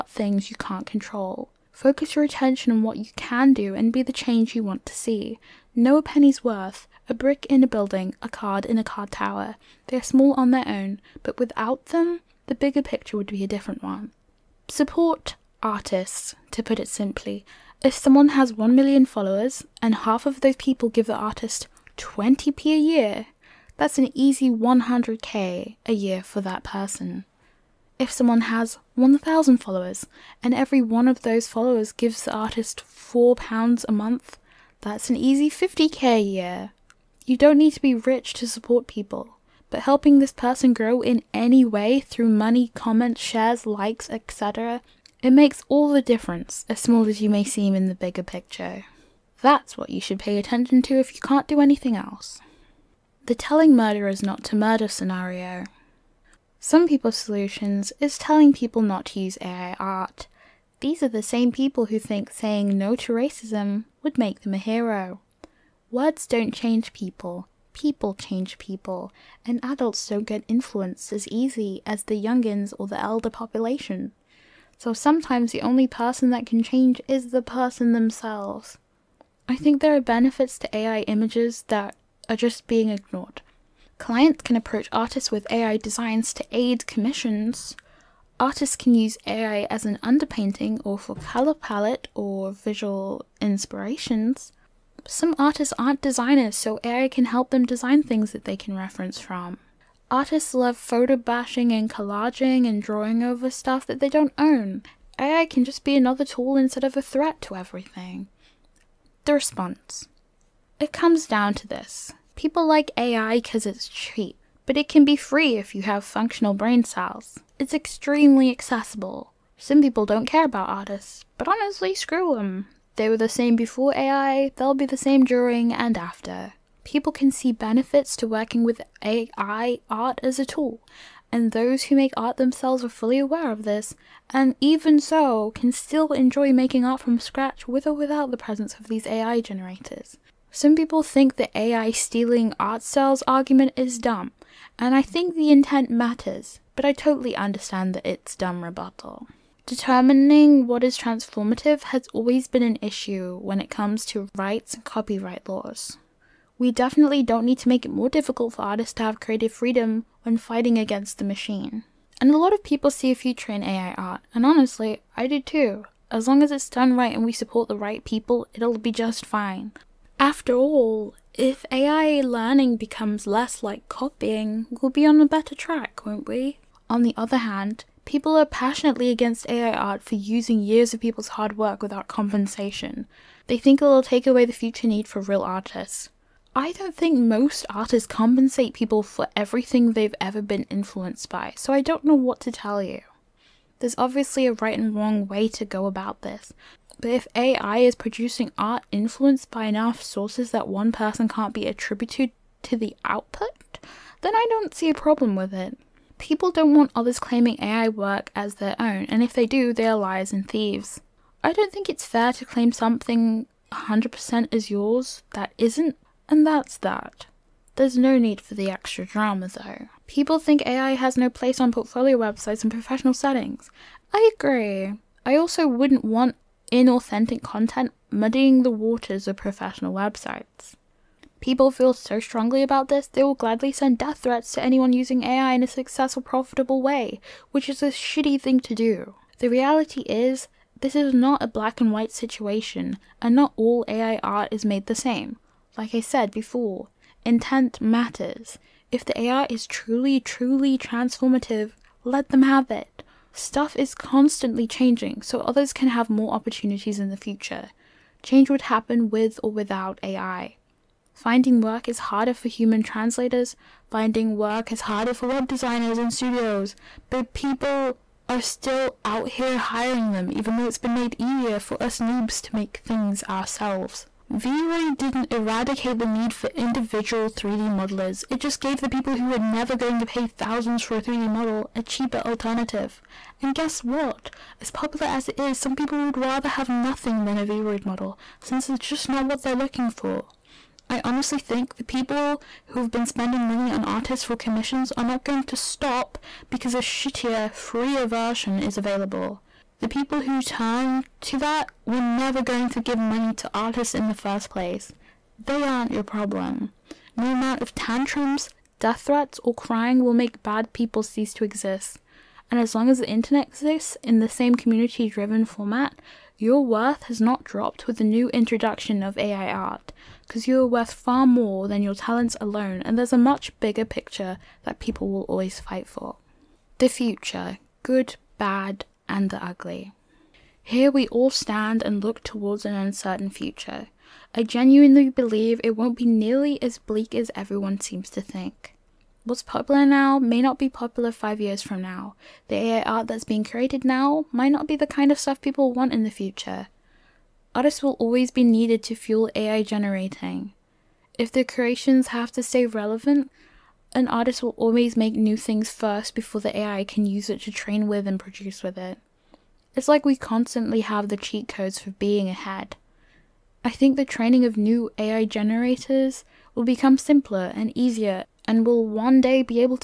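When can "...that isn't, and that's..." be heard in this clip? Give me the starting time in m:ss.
3:35.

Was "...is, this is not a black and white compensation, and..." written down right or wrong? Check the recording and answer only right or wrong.
wrong.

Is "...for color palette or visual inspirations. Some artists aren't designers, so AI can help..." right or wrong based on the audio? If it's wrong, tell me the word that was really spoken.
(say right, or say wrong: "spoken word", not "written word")
right.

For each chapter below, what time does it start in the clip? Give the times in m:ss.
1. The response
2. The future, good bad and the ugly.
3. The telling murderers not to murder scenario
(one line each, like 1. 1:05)
1. 1:48
2. 5:25
3. 0:52.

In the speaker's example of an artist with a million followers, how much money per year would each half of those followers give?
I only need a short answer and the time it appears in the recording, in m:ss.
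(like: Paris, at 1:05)
20p, at 0:21.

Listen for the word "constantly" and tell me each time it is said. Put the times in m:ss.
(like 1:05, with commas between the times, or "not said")
4:13, 6:00.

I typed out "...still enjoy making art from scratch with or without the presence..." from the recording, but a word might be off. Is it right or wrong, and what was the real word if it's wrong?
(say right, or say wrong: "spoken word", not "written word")
right.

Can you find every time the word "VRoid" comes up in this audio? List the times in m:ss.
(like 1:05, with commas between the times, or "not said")
4:34, 4:47.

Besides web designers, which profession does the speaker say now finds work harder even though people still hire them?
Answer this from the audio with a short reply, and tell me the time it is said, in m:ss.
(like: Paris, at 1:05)
human translators, at 4:22.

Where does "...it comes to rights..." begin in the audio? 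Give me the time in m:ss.
2:33.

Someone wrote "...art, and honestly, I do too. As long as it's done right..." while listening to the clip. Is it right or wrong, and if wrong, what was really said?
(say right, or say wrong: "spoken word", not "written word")
right.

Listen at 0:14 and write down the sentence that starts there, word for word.
Support artists, to put it simply.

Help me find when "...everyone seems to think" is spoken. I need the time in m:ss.
5:37.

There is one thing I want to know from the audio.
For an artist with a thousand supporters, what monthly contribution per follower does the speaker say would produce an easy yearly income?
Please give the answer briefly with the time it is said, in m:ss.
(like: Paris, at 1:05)
£4, at 0:32.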